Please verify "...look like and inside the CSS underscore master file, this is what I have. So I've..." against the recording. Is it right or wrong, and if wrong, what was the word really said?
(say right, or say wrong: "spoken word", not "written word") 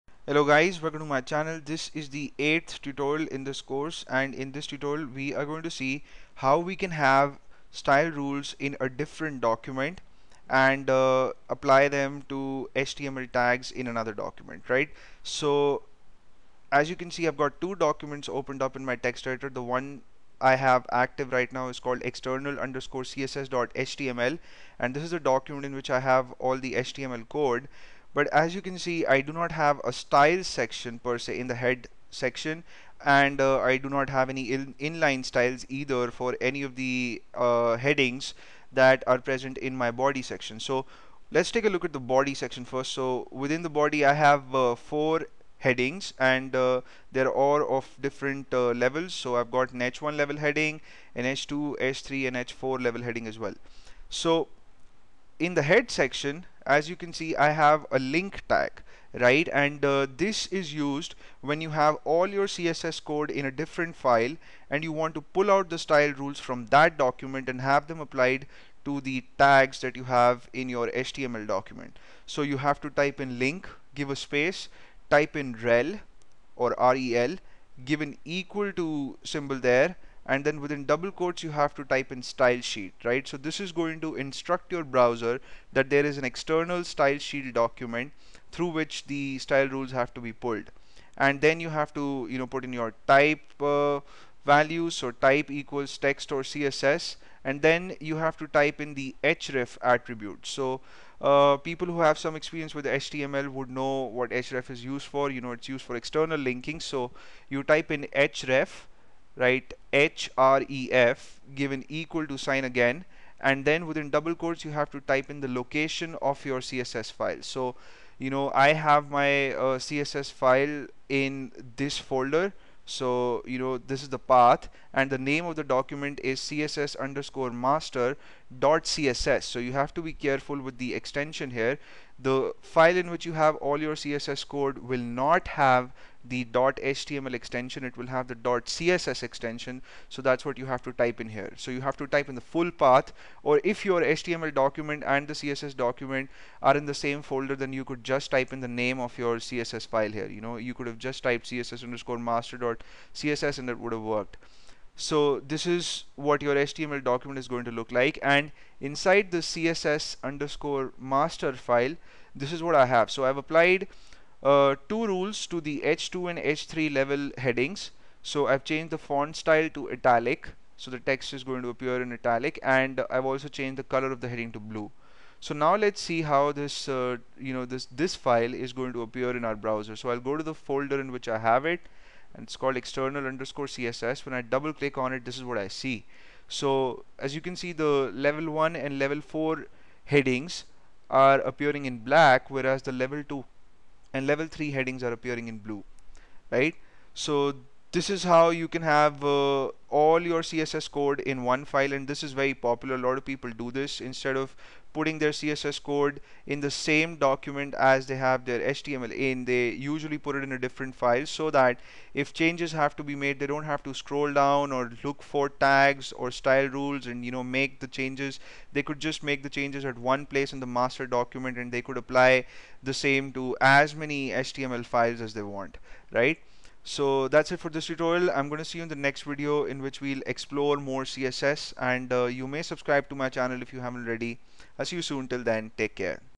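right.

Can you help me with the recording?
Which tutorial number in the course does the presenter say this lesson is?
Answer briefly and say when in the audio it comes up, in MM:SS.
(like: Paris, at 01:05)
8th, at 00:02.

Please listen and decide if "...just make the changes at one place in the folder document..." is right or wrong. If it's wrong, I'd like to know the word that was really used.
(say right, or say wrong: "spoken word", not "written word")
wrong: "master", not "folder".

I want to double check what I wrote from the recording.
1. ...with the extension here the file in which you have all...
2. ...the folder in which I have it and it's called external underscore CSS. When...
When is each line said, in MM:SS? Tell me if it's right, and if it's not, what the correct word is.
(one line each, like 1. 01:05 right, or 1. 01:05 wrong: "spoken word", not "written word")
1. 02:10 right
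2. 03:00 right.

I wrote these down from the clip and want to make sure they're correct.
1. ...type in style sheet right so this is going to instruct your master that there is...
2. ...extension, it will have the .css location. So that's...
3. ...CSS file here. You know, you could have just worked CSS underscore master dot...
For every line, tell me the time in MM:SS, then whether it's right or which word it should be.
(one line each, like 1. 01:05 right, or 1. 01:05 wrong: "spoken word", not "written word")
1. 01:21 wrong: "browser", not "master"
2. 02:17 wrong: "extension", not "location"
3. 02:29 wrong: "typed", not "worked".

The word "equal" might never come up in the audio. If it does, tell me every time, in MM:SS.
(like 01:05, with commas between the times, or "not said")
01:18, 01:35, 01:51.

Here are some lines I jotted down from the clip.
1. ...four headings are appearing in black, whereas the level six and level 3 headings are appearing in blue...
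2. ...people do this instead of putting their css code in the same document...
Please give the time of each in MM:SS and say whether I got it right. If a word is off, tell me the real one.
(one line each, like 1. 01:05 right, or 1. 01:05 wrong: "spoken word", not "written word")
1. 03:09 wrong: "two", not "six"
2. 03:23 right.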